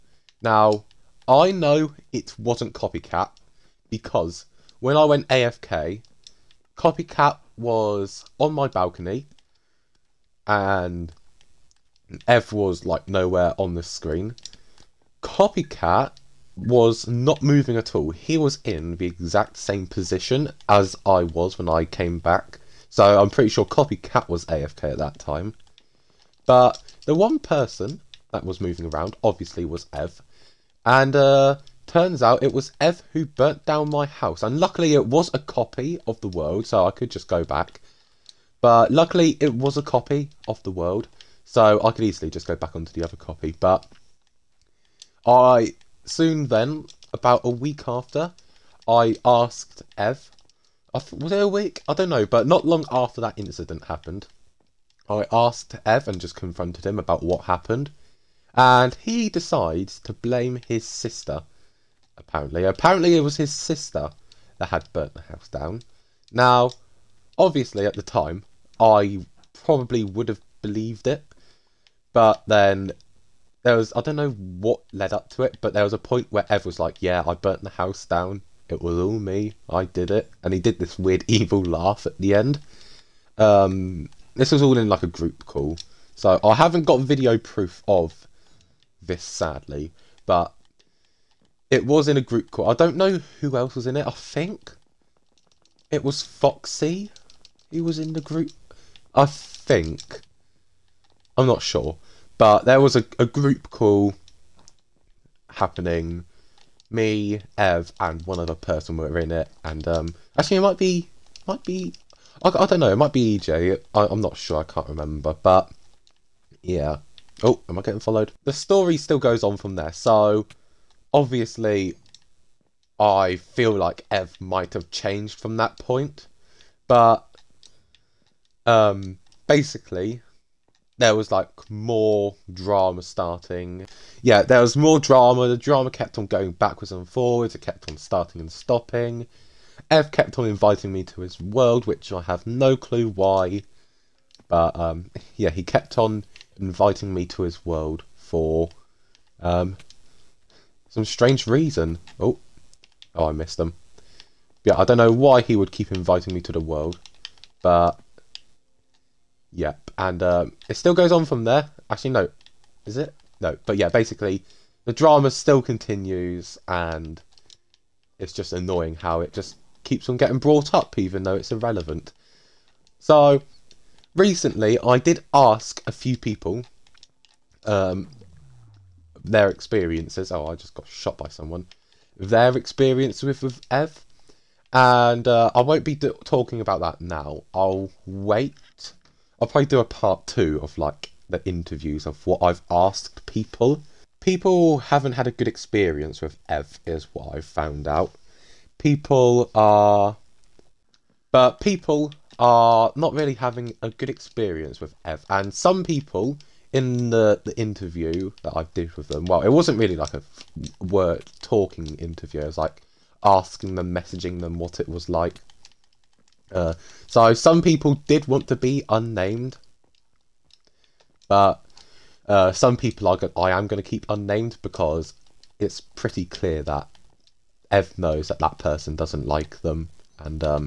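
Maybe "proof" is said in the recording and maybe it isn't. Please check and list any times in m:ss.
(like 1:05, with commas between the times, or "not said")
1:27.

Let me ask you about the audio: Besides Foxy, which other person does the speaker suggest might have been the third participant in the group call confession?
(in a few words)
EJ.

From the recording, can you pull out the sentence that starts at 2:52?
So recently, I did ask a few people um, their experiences.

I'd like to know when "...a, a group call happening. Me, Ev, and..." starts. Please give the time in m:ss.
1:42.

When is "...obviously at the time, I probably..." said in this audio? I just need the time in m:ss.
1:07.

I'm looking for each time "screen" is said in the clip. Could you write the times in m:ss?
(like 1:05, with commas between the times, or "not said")
0:13.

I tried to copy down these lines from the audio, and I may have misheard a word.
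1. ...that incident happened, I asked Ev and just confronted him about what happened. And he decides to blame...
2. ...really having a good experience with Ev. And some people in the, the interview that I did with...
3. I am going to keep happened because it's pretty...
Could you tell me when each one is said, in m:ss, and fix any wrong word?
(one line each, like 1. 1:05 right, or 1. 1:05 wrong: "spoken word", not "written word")
1. 0:53 right
2. 3:23 right
3. 3:43 wrong: "unnamed", not "happened".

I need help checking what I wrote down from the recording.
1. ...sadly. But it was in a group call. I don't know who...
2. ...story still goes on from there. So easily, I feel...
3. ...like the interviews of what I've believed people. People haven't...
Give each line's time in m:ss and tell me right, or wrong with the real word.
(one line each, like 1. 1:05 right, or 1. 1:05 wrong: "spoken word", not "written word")
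1. 1:29 right
2. 1:58 wrong: "obviously", not "easily"
3. 3:10 wrong: "asked", not "believed".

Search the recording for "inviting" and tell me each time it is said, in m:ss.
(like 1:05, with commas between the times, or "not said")
2:20, 2:26, 2:35.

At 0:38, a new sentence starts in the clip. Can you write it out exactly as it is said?
But luckily it was a copy of The World, so I could easily just go back onto the other copy.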